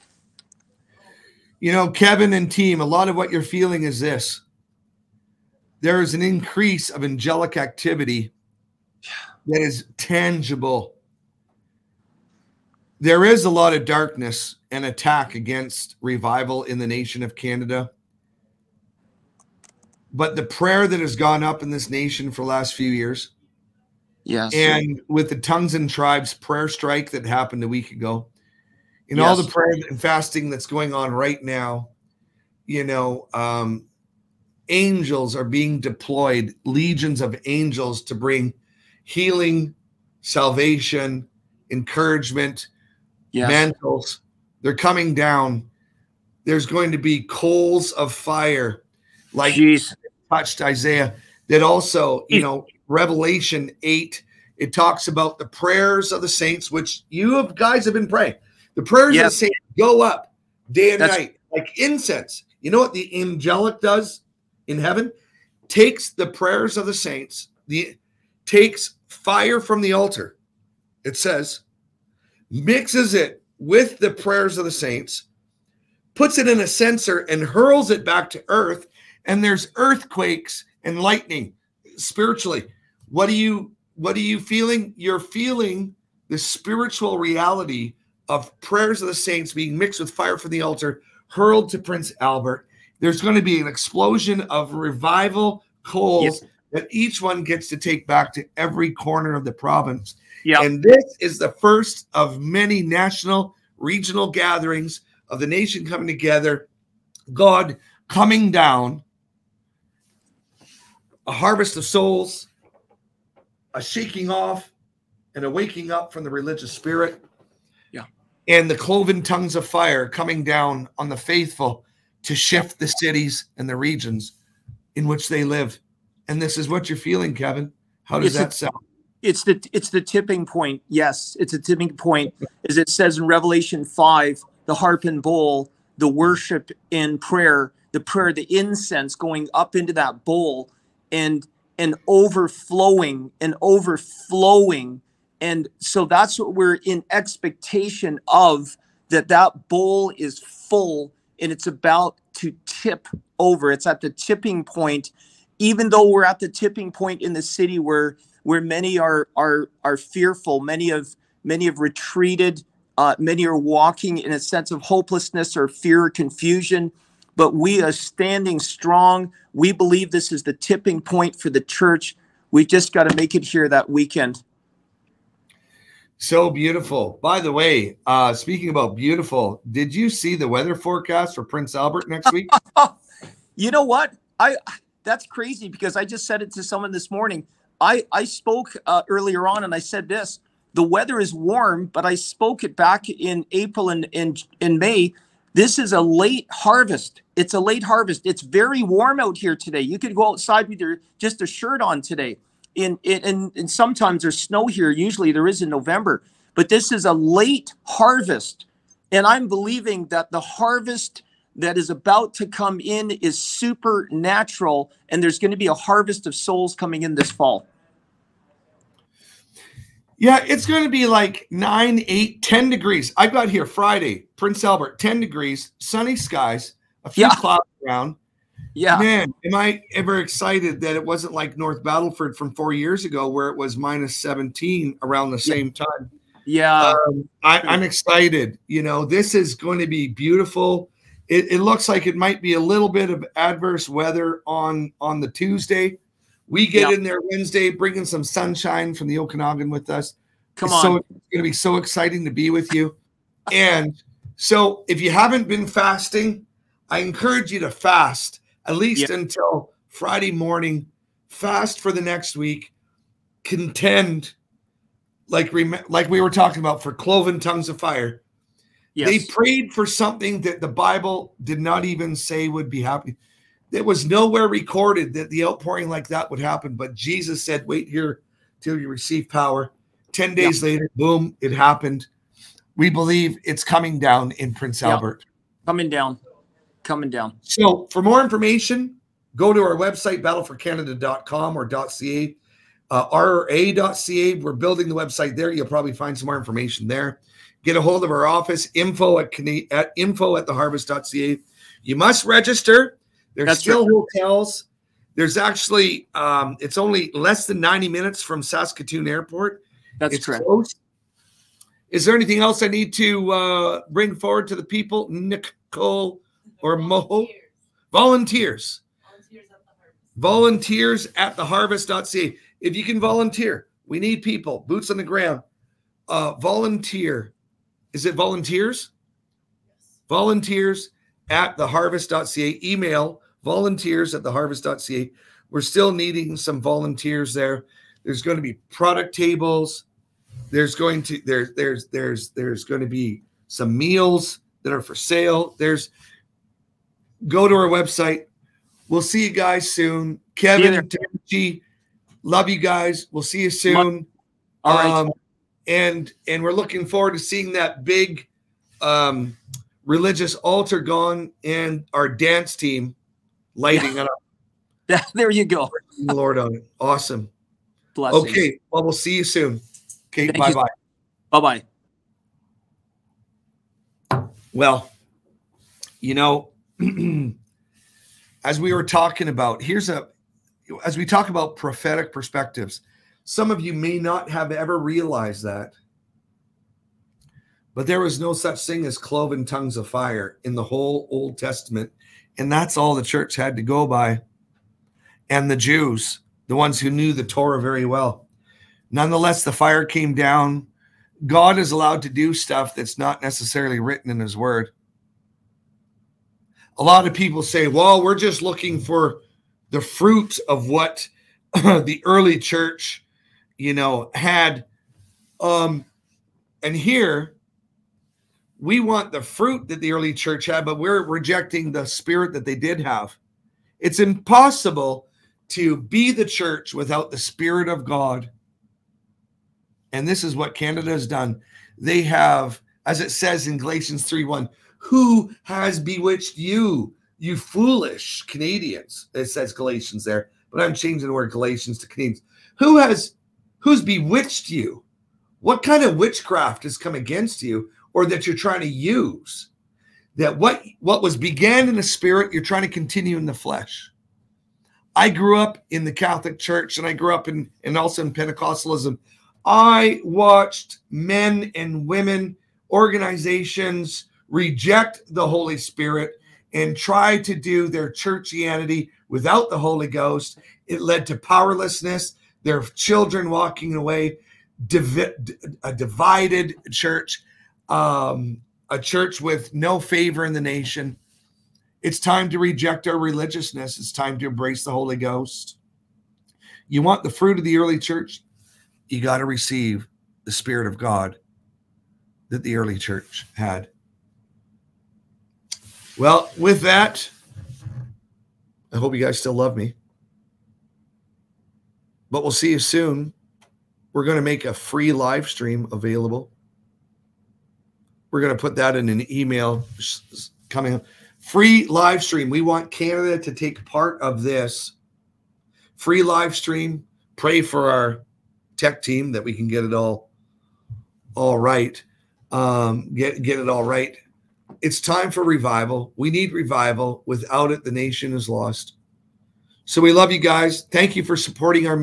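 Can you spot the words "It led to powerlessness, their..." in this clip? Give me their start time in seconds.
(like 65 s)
470 s.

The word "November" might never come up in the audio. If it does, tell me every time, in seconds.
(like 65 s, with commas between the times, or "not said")
205 s.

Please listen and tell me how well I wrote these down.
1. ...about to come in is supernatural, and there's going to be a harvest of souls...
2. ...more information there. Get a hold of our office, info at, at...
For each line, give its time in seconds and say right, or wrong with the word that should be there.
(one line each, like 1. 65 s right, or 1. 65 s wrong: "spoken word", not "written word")
1. 211 s right
2. 296 s right.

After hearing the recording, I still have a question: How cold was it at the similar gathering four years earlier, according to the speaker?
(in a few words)
-17.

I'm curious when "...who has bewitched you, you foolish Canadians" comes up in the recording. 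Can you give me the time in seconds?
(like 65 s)
434 s.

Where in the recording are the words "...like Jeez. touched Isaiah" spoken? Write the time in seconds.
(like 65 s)
49 s.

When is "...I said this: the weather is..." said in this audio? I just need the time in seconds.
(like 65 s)
189 s.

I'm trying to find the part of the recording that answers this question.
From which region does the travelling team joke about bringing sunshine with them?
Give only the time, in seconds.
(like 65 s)
249 s.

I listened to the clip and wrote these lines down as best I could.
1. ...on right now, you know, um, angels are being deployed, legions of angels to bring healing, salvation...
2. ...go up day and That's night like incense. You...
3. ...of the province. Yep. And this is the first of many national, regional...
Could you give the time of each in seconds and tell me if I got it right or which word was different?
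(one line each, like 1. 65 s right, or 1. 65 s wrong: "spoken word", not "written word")
1. 30 s right
2. 59 s right
3. 99 s right.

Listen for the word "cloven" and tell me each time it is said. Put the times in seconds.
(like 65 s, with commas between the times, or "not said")
118 s, 266 s, 388 s.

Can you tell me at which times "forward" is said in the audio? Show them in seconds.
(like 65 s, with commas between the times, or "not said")
314 s, 356 s.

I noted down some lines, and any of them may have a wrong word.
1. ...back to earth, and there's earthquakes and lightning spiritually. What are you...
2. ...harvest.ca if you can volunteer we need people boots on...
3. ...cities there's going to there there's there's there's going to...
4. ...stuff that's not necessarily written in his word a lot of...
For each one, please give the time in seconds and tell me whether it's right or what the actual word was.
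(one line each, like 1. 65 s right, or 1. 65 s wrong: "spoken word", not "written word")
1. 78 s right
2. 321 s right
3. 339 s wrong: "tables", not "cities"
4. 402 s right.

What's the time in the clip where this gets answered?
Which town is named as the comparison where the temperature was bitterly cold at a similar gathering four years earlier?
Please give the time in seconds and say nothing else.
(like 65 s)
231 s.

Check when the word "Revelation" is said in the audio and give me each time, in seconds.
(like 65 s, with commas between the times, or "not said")
52 s, 133 s.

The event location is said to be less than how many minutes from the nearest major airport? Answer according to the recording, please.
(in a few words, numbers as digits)
90 minutes.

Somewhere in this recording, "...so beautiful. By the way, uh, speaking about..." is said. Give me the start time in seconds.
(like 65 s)
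176 s.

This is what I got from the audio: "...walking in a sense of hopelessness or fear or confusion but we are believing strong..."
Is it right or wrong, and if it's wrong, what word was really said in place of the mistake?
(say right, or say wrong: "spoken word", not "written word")
wrong: "standing", not "believing".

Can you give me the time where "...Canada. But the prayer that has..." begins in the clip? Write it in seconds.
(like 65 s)
17 s.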